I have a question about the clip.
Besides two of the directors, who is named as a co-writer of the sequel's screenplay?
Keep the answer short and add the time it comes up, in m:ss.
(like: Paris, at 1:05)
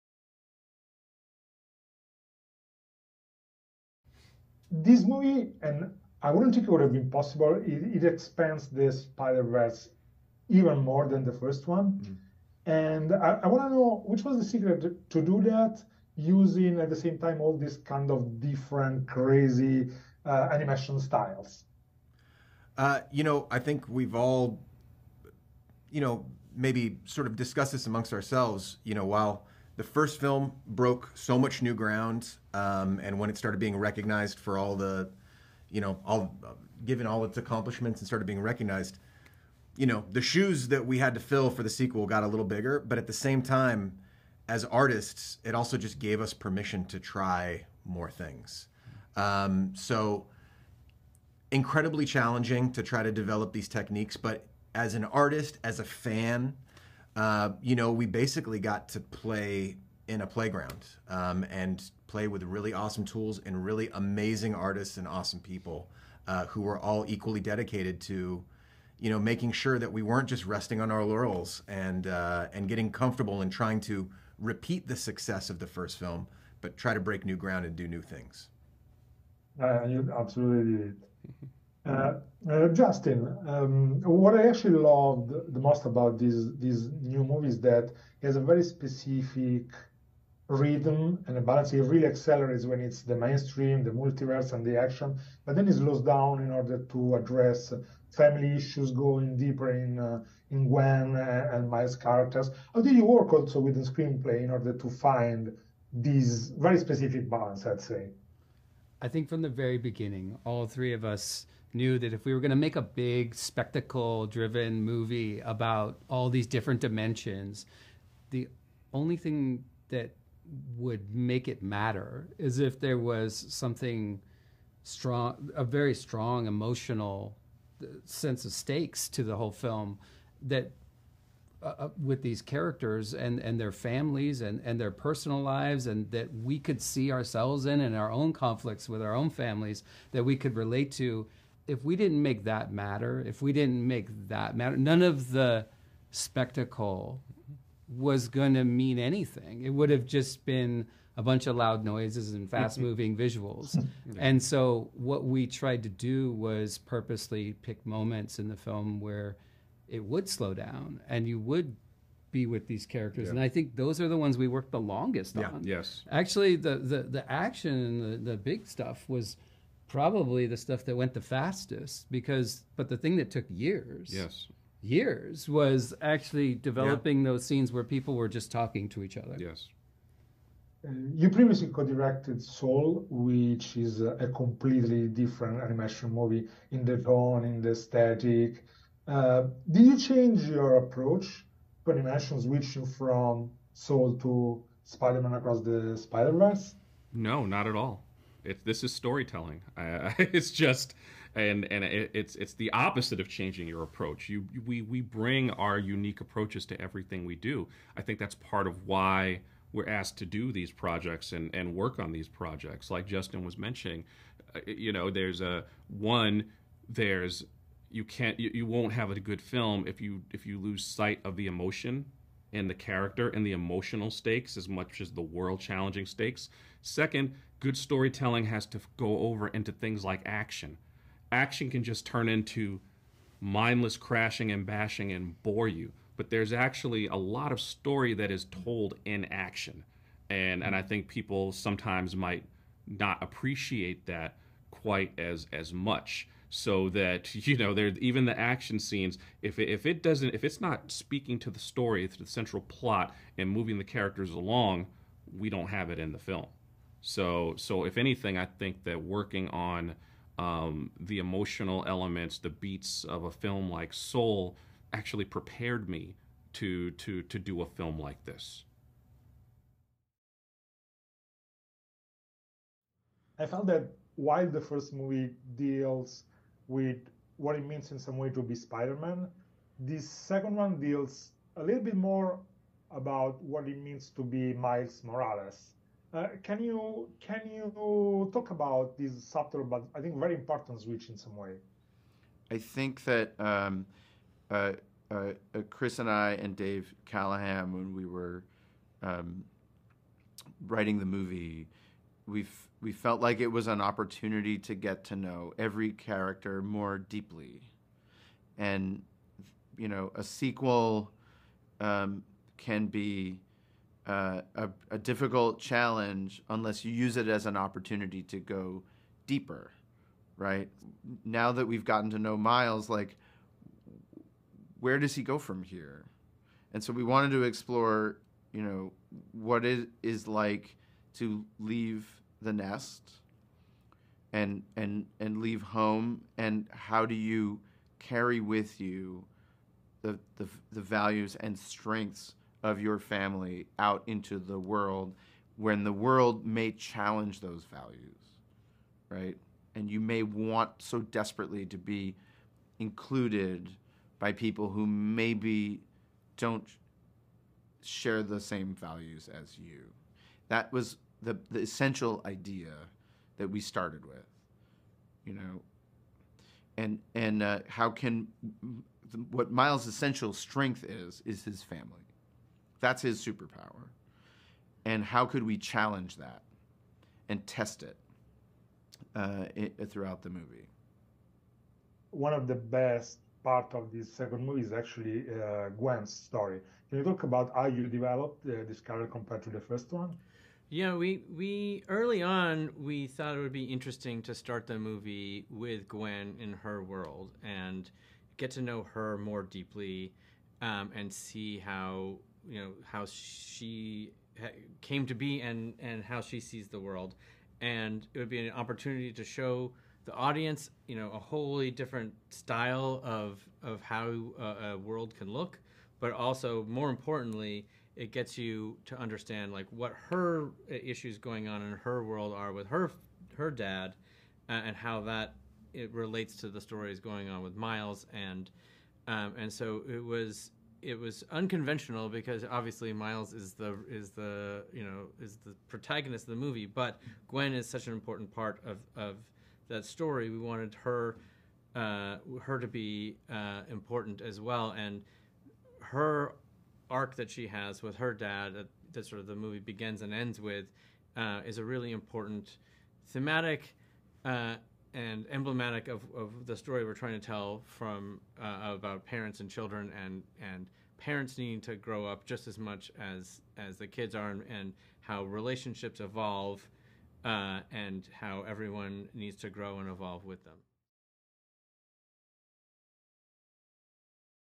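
Dave Callaham, at 4:56.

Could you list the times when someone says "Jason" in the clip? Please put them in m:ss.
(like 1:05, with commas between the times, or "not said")
not said.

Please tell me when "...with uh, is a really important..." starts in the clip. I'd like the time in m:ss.
7:30.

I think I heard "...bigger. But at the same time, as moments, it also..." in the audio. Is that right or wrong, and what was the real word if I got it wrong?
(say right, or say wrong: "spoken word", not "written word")
wrong: "artists", not "moments".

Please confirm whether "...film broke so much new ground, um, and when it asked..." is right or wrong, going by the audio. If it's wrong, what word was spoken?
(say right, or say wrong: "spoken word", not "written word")
wrong: "started", not "asked".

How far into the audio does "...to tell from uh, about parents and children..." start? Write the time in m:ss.
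7:37.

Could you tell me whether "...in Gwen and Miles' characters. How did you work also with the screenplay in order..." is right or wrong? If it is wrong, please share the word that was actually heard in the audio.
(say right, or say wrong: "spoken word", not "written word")
right.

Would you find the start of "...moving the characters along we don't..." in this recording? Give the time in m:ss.
4:13.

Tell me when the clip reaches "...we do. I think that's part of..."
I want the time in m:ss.
3:27.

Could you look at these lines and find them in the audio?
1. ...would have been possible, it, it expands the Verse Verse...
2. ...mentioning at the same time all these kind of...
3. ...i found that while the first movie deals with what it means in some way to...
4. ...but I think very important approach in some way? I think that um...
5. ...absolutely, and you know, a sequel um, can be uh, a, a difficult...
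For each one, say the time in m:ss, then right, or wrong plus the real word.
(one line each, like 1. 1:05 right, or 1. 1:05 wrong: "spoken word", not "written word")
1. 0:06 wrong: "Spider", not "Verse"
2. 0:16 wrong: "using", not "mentioning"
3. 4:33 right
4. 4:49 wrong: "switch", not "approach"
5. 5:06 wrong: "deeply", not "absolutely".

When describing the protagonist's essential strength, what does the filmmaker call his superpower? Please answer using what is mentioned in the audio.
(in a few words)
his family.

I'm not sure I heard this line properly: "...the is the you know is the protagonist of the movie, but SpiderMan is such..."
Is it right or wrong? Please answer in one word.
wrong.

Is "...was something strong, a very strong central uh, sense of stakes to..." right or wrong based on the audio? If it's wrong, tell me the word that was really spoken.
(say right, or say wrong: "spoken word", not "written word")
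wrong: "emotional", not "central".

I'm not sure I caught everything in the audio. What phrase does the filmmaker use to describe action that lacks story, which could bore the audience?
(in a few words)
mindless crashing and bashing.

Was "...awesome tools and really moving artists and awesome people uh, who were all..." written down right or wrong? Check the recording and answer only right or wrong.
wrong.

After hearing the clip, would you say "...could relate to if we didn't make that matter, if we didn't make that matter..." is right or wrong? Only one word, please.
right.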